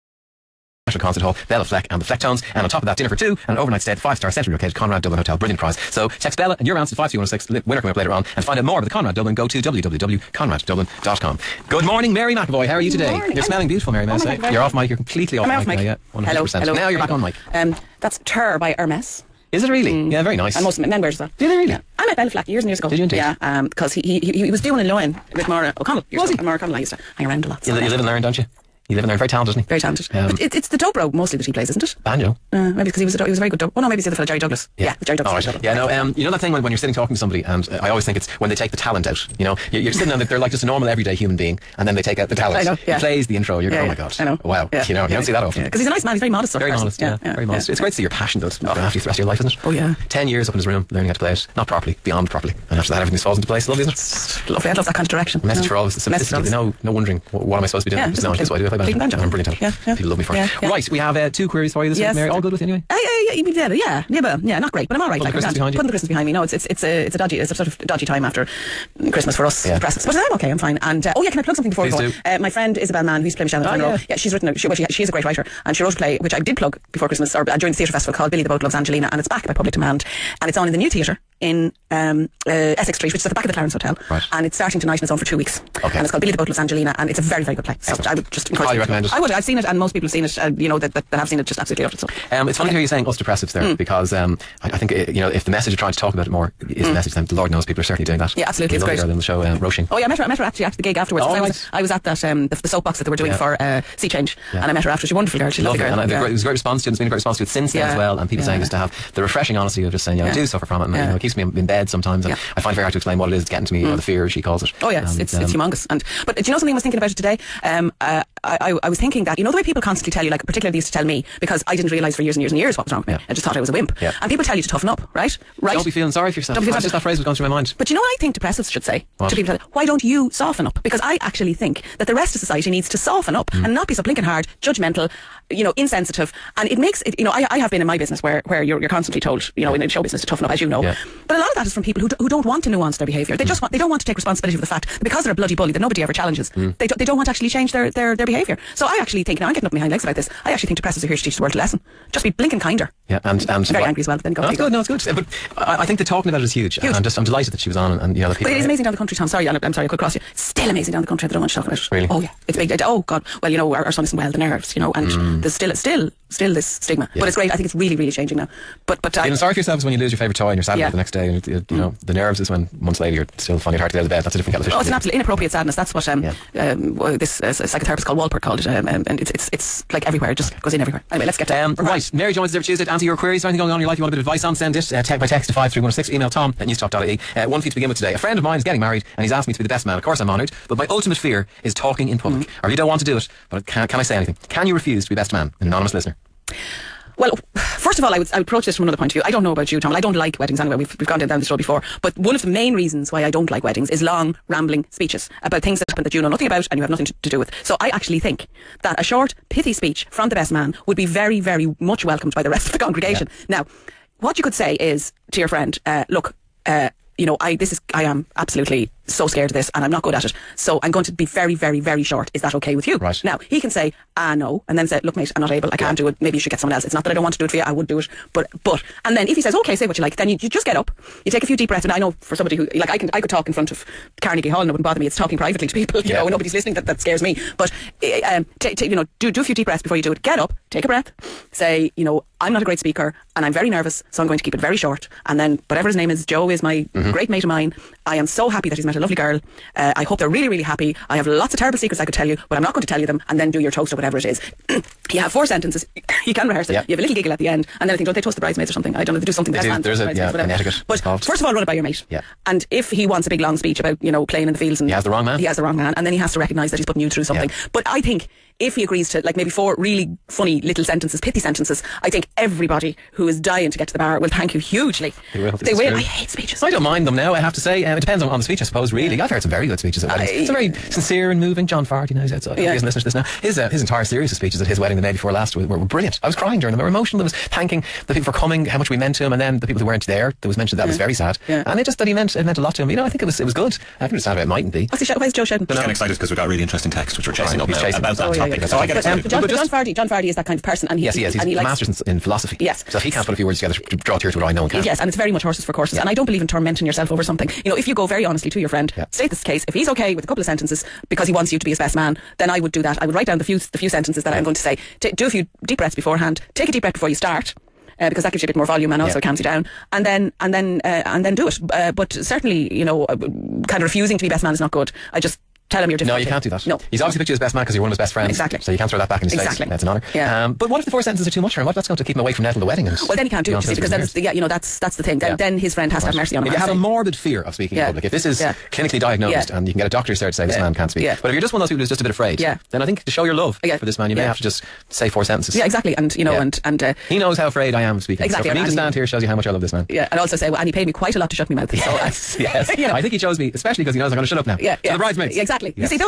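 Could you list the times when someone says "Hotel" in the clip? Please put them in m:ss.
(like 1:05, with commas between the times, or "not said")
0:05, 1:23.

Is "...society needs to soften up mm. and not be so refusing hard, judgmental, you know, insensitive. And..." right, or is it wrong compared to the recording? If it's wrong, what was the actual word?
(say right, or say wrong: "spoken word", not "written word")
wrong: "blinking", not "refusing".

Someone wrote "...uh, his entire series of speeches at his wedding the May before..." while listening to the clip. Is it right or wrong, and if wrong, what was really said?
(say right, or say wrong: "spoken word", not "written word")
right.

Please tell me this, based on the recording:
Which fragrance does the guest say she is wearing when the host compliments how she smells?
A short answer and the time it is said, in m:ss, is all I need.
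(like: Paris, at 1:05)
Terre by Hermes, at 0:18.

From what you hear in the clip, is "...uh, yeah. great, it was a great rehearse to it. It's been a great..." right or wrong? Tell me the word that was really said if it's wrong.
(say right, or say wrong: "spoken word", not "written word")
wrong: "response", not "rehearse".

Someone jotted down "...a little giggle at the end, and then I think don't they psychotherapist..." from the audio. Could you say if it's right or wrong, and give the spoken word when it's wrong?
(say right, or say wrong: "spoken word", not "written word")
wrong: "toast", not "psychotherapist".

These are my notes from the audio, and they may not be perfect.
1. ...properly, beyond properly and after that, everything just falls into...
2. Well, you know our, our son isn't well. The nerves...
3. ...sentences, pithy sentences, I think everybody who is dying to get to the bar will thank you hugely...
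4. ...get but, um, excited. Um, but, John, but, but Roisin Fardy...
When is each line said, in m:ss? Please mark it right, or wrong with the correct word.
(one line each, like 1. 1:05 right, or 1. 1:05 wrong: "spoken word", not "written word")
1. 0:51 right
2. 2:43 right
3. 4:30 right
4. 4:58 wrong: "John", not "Roisin".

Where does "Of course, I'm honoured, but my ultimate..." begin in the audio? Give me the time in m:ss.
3:09.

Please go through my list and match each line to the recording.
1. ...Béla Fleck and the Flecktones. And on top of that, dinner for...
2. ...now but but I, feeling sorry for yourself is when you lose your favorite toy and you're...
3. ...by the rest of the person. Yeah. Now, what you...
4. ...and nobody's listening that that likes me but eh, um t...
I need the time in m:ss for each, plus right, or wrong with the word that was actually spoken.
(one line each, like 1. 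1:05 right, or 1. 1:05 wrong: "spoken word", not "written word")
1. 0:01 right
2. 2:48 right
3. 3:32 wrong: "congregation", not "person"
4. 3:56 wrong: "scares", not "likes".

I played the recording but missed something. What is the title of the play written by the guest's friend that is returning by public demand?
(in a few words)
Billy the Boat Loves Angelina.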